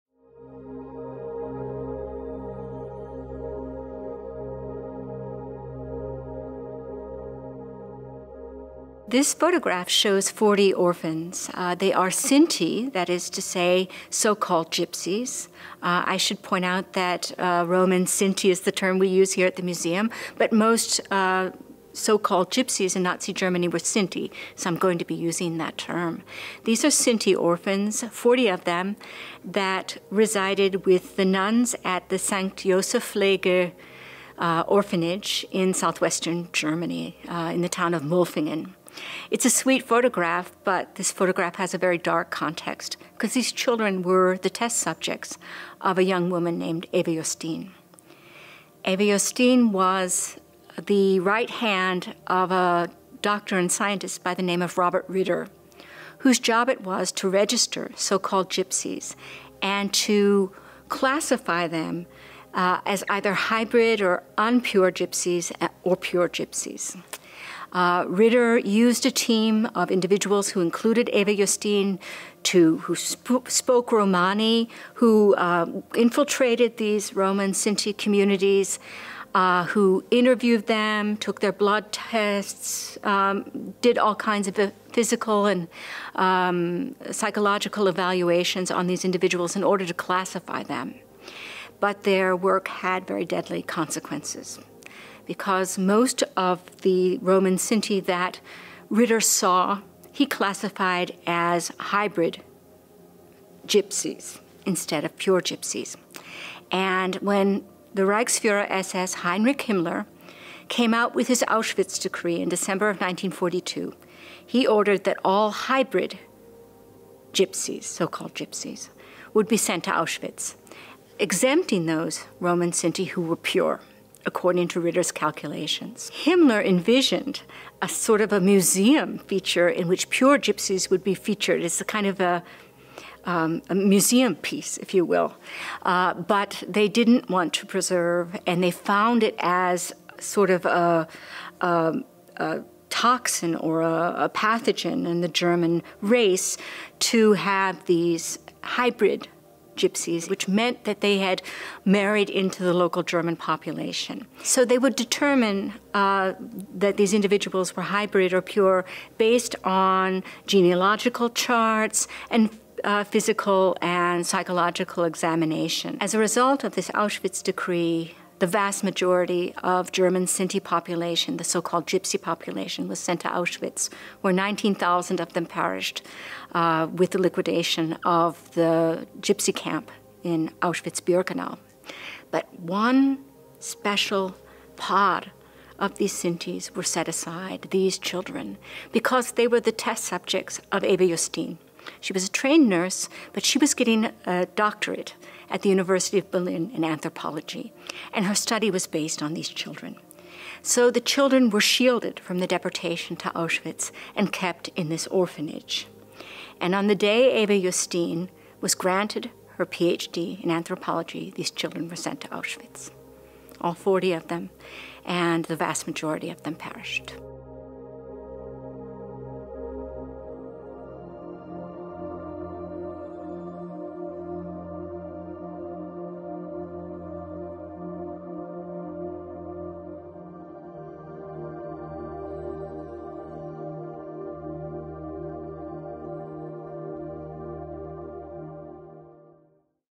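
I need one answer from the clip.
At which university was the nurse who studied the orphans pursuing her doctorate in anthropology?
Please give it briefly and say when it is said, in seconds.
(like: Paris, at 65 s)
University of Berlin, at 195 s.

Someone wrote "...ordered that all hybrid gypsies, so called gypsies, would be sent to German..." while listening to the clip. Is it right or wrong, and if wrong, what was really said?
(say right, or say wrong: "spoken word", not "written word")
wrong: "Auschwitz", not "German".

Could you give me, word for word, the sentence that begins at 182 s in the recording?
But one special pod of these Sintis were set aside, these children, because they were the test subjects of Eva Justin.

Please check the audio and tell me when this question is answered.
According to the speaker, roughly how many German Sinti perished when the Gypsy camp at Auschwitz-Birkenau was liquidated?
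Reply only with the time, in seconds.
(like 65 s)
174 s.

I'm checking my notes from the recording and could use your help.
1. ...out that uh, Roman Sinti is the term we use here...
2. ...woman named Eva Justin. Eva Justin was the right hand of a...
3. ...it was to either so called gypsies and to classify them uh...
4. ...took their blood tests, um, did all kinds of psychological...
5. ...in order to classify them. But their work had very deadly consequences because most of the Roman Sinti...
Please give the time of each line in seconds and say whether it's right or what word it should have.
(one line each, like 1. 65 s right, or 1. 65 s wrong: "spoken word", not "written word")
1. 16 s right
2. 46 s right
3. 56 s wrong: "register", not "either"
4. 81 s wrong: "physical", not "psychological"
5. 89 s right.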